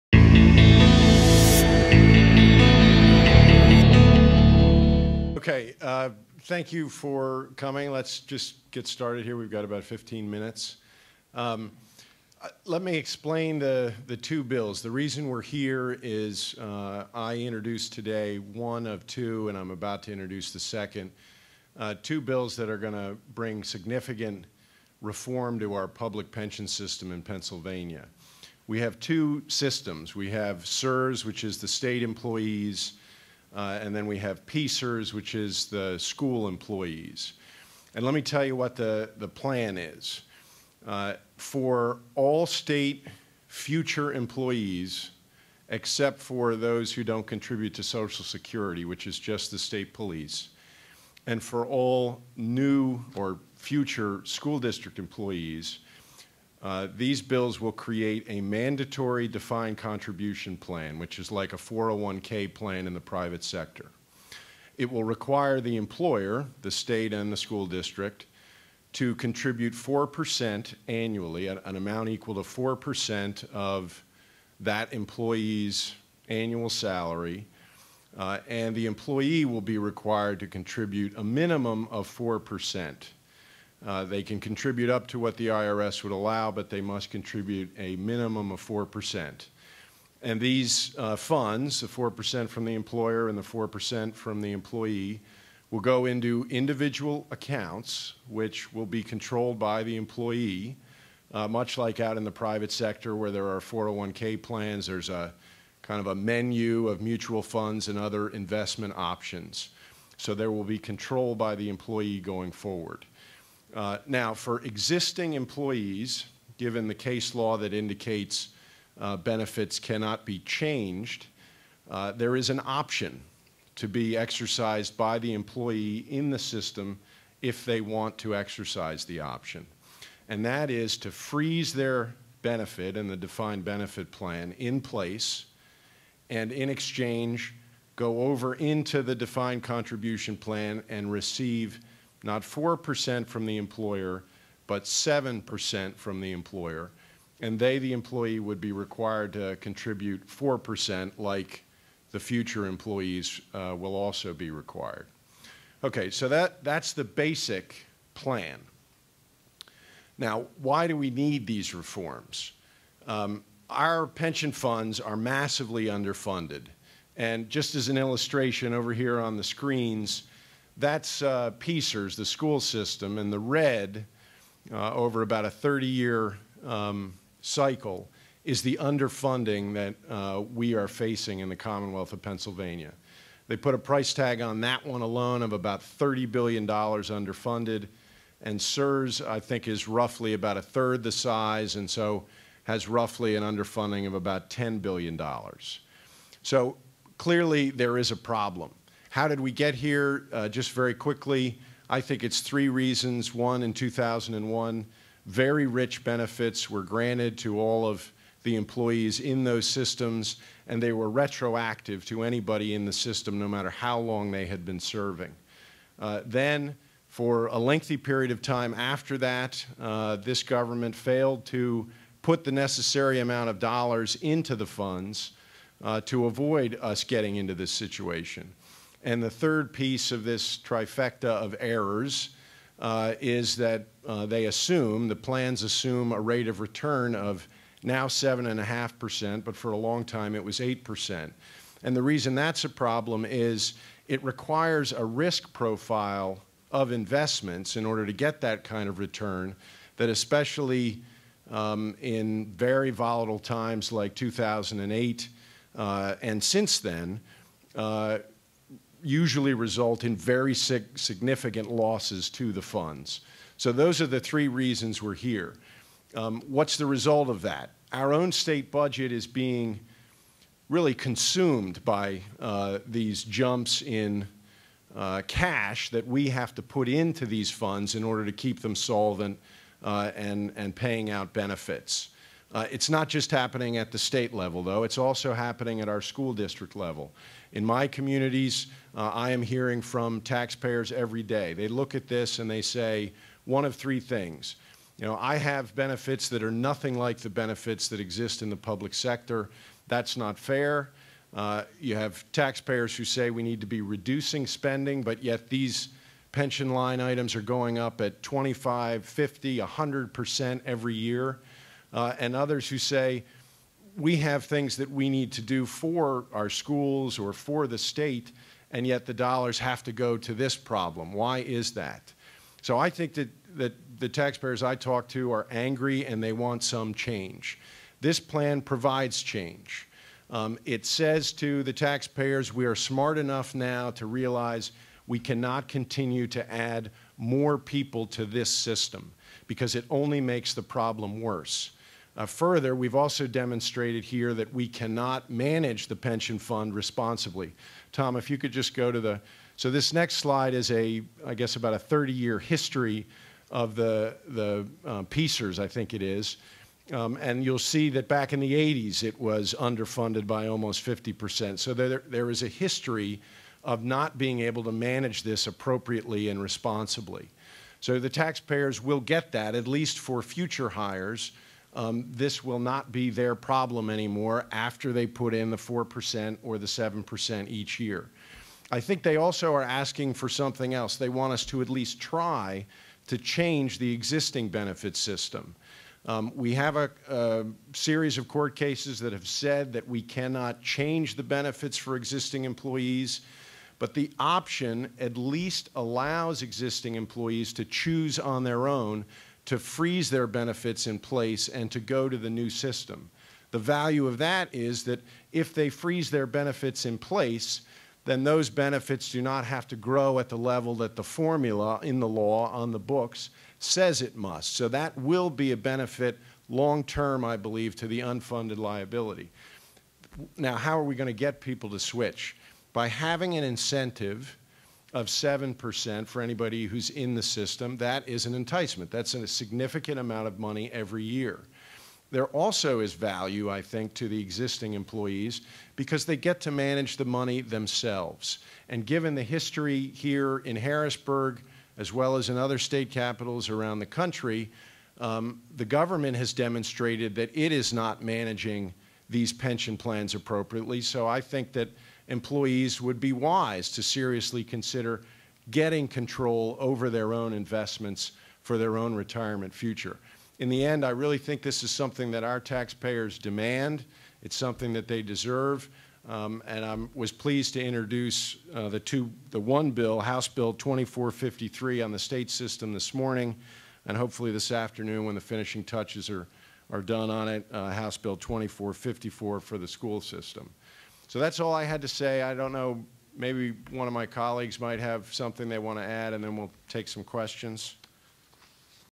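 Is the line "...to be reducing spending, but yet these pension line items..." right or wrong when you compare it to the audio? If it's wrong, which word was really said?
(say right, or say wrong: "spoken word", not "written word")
right.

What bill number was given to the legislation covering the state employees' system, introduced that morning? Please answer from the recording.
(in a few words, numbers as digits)
House Bill 2453.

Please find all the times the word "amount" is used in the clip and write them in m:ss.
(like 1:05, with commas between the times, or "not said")
1:11, 3:43, 7:09.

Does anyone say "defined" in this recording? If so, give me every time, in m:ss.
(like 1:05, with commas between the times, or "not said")
0:59, 2:13, 2:19.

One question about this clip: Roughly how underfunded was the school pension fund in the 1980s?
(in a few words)
almost 50%.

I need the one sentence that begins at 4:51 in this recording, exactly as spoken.
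They look at this and they say one of three things.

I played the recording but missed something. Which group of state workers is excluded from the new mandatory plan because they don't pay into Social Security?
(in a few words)
state police.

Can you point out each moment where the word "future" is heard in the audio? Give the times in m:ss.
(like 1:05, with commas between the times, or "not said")
0:43, 0:53, 2:32, 6:10, 7:39.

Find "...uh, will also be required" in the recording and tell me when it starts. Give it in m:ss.
2:33.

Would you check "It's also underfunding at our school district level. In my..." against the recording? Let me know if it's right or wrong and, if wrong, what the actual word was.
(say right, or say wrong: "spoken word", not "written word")
wrong: "happening", not "underfunding".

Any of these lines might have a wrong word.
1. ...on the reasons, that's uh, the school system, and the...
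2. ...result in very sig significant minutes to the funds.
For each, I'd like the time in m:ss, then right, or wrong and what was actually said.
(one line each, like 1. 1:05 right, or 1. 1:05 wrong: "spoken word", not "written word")
1. 2:49 wrong: "screens", not "reasons"
2. 4:19 wrong: "losses", not "minutes".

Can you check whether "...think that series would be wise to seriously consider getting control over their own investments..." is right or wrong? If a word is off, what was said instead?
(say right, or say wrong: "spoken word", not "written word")
wrong: "employees", not "series".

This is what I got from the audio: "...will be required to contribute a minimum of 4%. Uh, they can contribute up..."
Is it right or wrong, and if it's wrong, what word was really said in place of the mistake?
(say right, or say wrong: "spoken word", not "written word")
right.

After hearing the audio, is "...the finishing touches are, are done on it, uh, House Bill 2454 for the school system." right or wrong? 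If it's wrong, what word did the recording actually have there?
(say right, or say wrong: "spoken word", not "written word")
right.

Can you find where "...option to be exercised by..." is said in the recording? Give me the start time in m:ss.
2:02.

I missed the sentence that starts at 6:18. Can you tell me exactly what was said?
I think they also are asking for something else.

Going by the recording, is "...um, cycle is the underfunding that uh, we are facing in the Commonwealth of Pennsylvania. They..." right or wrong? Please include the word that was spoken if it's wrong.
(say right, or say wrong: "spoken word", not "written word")
right.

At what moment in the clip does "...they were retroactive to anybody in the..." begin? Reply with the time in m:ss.
3:30.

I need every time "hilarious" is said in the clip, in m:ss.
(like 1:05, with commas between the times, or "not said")
not said.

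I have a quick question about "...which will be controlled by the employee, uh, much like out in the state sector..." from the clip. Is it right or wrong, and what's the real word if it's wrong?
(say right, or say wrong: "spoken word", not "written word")
wrong: "private", not "state".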